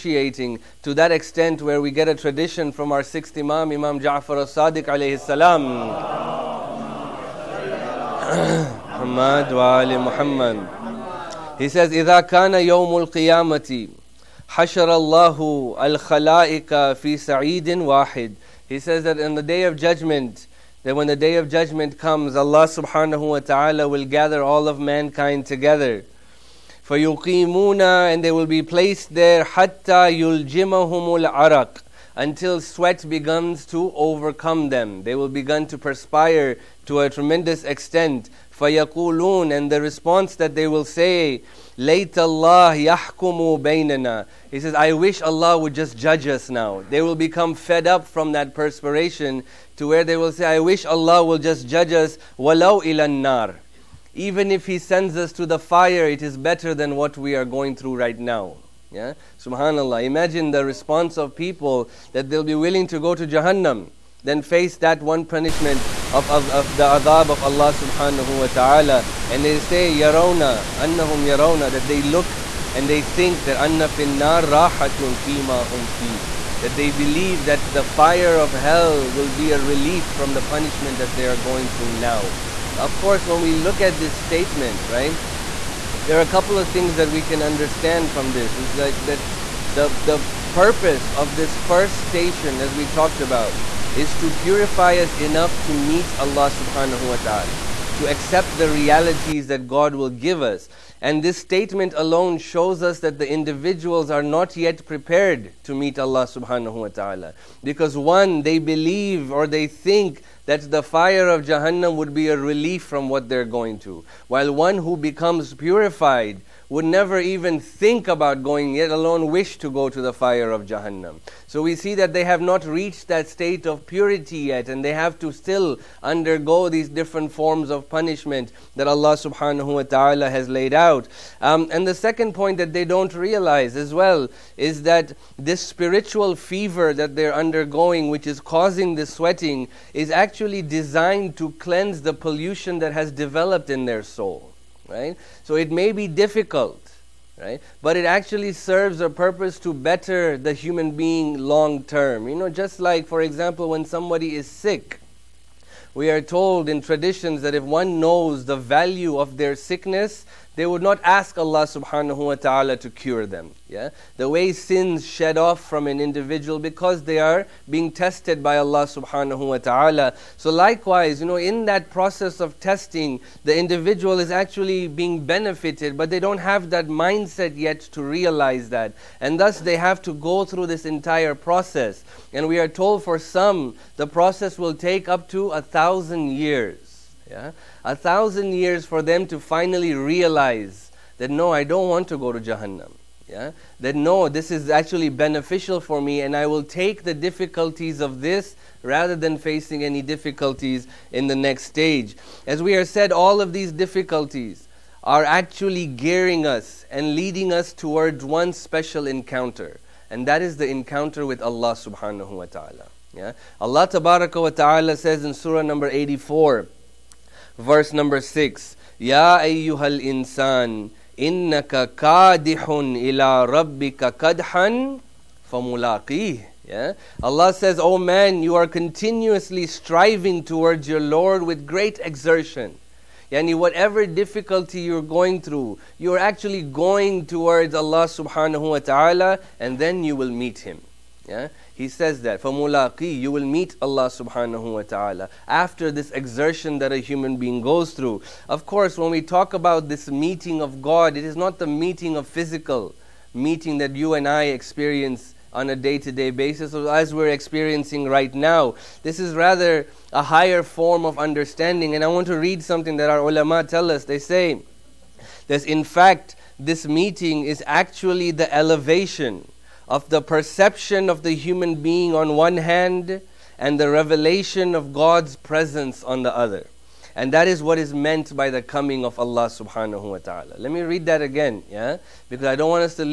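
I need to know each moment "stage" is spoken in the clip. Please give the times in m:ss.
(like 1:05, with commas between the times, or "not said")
3:21.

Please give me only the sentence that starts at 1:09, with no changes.
And they say, Yarona, annahum yarona, that they look and they think that anna finnar rahatun fima hum fi.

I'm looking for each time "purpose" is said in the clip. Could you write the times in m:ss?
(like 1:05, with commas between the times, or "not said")
1:30, 2:29.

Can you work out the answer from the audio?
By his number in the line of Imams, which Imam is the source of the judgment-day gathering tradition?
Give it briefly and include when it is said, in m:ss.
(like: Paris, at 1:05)
Sixth Imam, at 0:03.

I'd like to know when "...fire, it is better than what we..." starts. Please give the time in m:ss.
0:55.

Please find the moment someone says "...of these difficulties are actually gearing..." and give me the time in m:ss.
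3:23.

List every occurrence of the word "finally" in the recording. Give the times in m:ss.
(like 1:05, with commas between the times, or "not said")
3:09.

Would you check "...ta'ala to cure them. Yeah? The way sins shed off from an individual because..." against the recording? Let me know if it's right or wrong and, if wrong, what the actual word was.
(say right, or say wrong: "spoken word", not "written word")
right.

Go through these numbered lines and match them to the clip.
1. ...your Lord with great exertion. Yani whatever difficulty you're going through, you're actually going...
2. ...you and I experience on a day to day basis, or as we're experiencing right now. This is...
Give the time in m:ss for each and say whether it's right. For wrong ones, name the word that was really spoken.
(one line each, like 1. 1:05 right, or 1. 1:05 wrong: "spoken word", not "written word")
1. 3:50 right
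2. 4:13 right.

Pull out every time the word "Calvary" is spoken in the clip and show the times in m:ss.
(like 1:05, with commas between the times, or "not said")
not said.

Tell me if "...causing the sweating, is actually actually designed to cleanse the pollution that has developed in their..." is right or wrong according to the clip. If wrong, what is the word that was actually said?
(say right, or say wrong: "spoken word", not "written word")
right.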